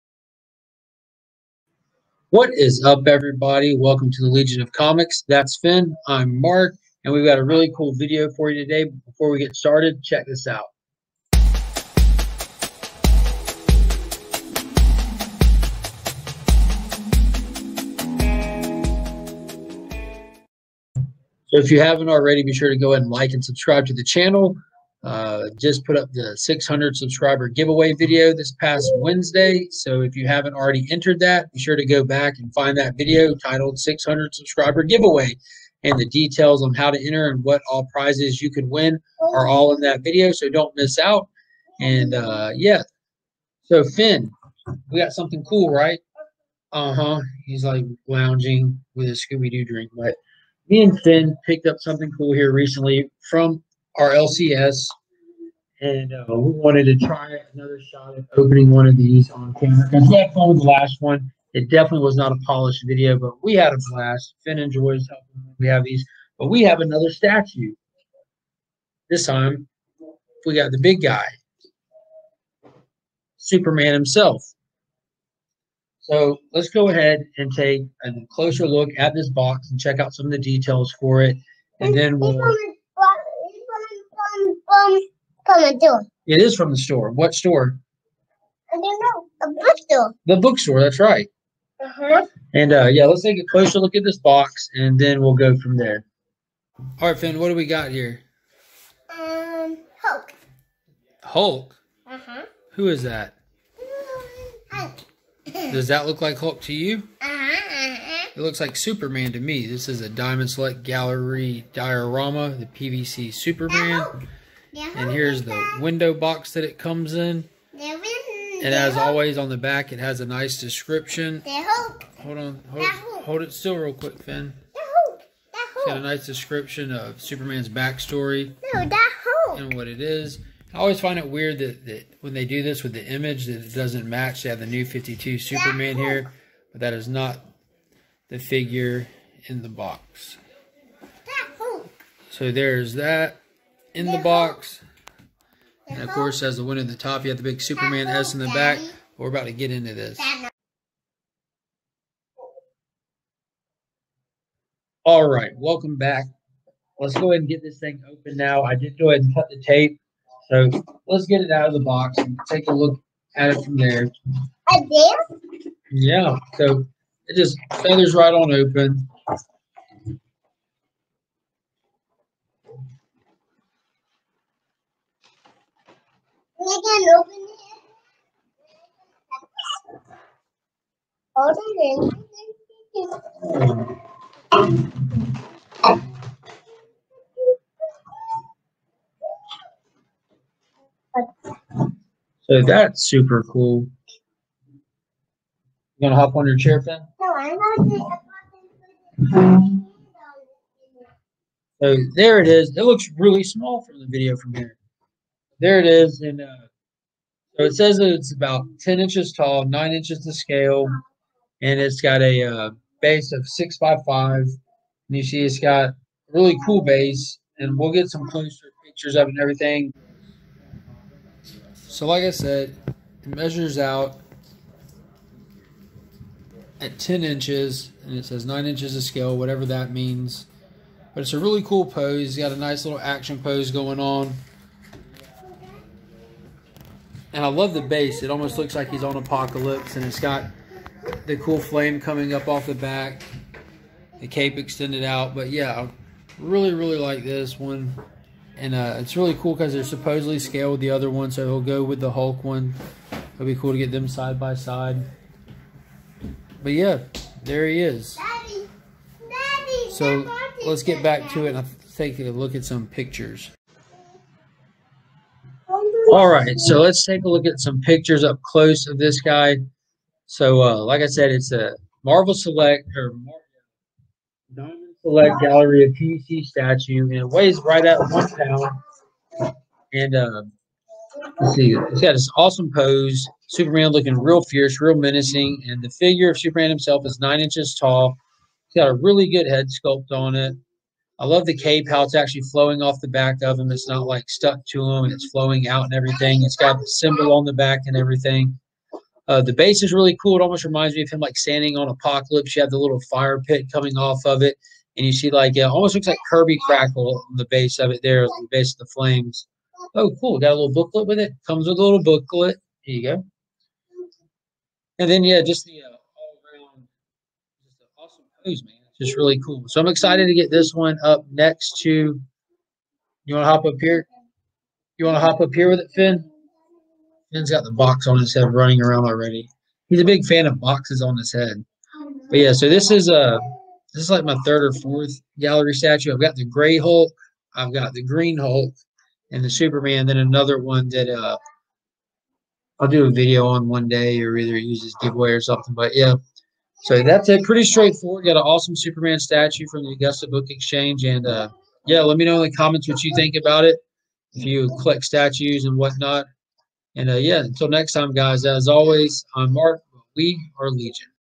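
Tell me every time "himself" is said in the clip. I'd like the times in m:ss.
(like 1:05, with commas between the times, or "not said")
1:13, 4:46.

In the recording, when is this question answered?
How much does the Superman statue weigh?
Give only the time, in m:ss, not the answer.
4:37.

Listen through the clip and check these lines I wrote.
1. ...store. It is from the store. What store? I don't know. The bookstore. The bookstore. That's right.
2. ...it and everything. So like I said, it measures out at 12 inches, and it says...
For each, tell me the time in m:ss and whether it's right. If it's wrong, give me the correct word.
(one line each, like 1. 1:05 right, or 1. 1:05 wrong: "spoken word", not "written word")
1. 1:25 right
2. 3:39 wrong: "10", not "12".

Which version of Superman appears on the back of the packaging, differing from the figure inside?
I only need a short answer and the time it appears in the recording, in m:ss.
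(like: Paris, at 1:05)
New 52, at 2:14.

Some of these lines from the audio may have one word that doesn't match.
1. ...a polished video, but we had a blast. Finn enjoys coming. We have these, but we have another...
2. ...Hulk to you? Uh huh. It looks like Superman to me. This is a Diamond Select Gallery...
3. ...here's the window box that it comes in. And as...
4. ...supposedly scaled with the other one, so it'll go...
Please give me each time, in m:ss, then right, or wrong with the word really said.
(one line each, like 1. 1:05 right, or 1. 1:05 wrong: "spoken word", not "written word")
1. 1:02 wrong: "helping", not "coming"
2. 1:46 right
3. 1:55 right
4. 4:09 right.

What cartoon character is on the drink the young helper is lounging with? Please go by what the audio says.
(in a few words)
Scooby Doo.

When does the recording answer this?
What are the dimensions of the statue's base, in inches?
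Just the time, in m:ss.
3:33.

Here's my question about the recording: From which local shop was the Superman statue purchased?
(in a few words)
Augusta Book Exchange.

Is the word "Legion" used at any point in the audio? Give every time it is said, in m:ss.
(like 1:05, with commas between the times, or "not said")
0:04, 6:00.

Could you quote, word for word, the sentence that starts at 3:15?
You gonna hop on your chair, Finn?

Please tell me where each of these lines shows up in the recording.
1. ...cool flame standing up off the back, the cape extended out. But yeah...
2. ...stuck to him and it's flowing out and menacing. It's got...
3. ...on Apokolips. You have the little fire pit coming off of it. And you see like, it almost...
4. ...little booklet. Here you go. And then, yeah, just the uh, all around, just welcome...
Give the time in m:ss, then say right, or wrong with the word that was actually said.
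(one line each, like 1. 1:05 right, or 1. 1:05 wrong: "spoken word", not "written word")
1. 4:01 wrong: "coming", not "standing"
2. 4:54 wrong: "everything", not "menacing"
3. 5:01 right
4. 5:11 wrong: "awesome", not "welcome".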